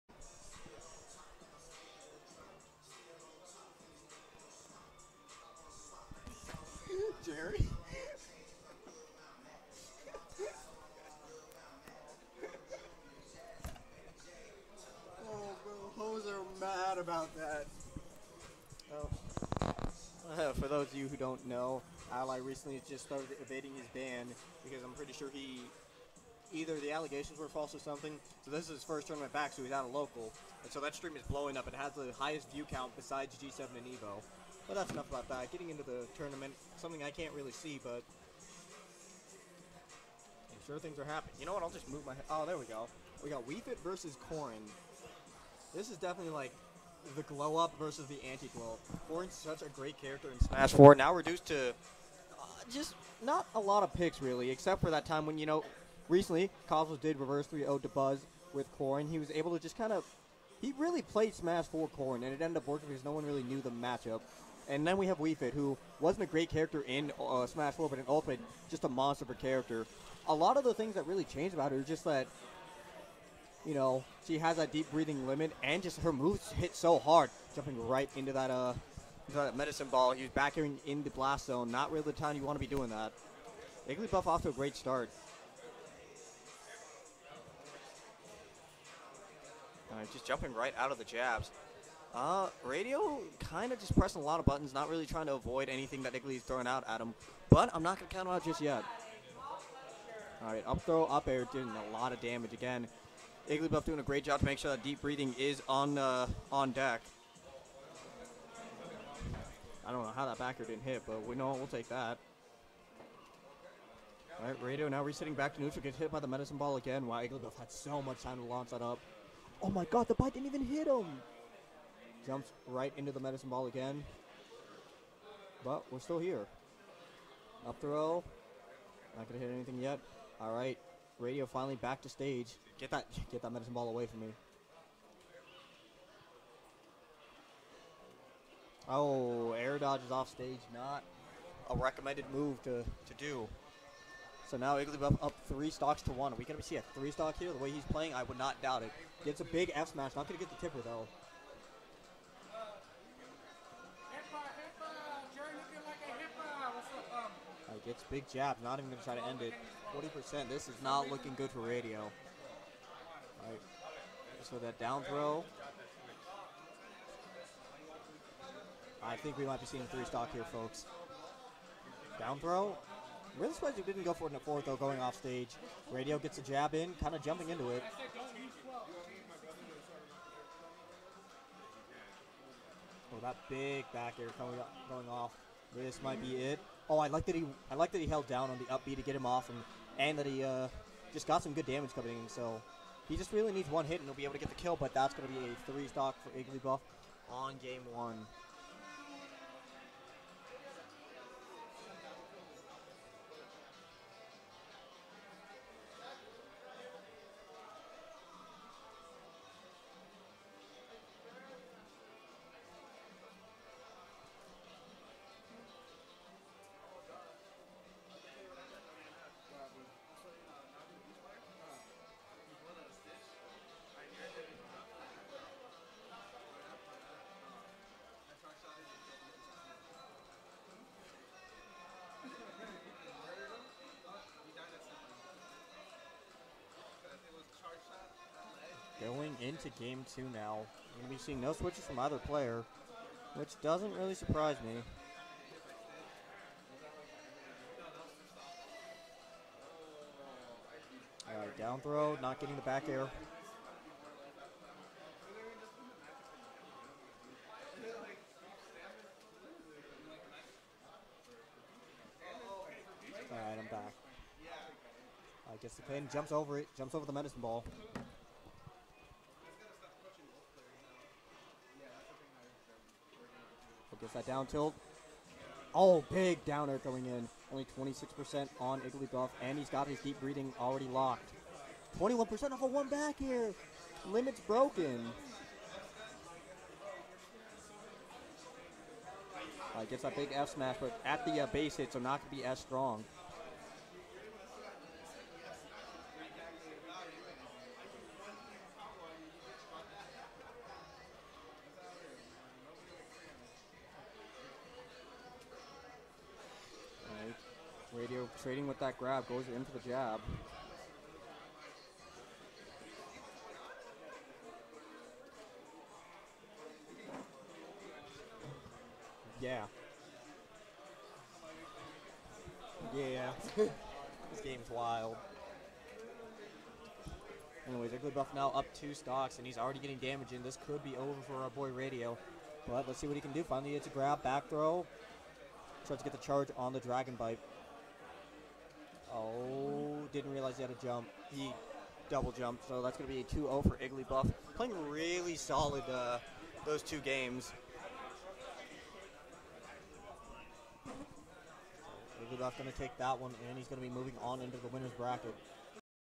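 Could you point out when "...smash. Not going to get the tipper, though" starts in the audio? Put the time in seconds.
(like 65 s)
149 s.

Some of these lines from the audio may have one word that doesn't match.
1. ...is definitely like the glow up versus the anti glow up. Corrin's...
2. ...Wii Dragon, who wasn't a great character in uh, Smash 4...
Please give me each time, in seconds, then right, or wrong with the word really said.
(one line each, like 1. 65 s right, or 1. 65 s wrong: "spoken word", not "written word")
1. 45 s right
2. 65 s wrong: "Fit", not "Dragon".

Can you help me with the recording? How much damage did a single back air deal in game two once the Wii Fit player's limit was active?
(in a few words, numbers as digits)
21%.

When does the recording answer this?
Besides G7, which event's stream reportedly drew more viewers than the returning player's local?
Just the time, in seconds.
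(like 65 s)
33 s.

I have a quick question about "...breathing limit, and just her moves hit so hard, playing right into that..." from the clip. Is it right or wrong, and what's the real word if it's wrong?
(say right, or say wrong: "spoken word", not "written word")
wrong: "jumping", not "playing".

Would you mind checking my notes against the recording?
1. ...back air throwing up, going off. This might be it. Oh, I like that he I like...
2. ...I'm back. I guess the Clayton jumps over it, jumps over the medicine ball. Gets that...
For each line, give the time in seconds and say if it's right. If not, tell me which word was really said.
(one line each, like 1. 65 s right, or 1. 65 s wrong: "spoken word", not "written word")
1. 183 s wrong: "coming", not "throwing"
2. 263 s right.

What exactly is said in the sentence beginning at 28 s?
So this is his first tournament back, so he's out of local.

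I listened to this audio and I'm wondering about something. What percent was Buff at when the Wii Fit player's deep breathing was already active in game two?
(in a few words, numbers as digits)
26%.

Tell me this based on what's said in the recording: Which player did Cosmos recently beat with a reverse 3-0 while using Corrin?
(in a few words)
Buzz.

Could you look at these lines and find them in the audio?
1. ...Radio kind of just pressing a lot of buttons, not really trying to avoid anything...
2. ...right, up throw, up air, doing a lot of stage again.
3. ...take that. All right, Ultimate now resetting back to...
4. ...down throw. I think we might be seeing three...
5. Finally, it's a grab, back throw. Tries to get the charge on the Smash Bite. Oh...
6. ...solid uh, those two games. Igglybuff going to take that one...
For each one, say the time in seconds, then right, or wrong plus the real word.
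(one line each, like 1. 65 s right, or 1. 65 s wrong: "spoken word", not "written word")
1. 92 s right
2. 100 s wrong: "damage", not "stage"
3. 111 s wrong: "Radio", not "Ultimate"
4. 164 s right
5. 333 s wrong: "Dragon", not "Smash"
6. 345 s right.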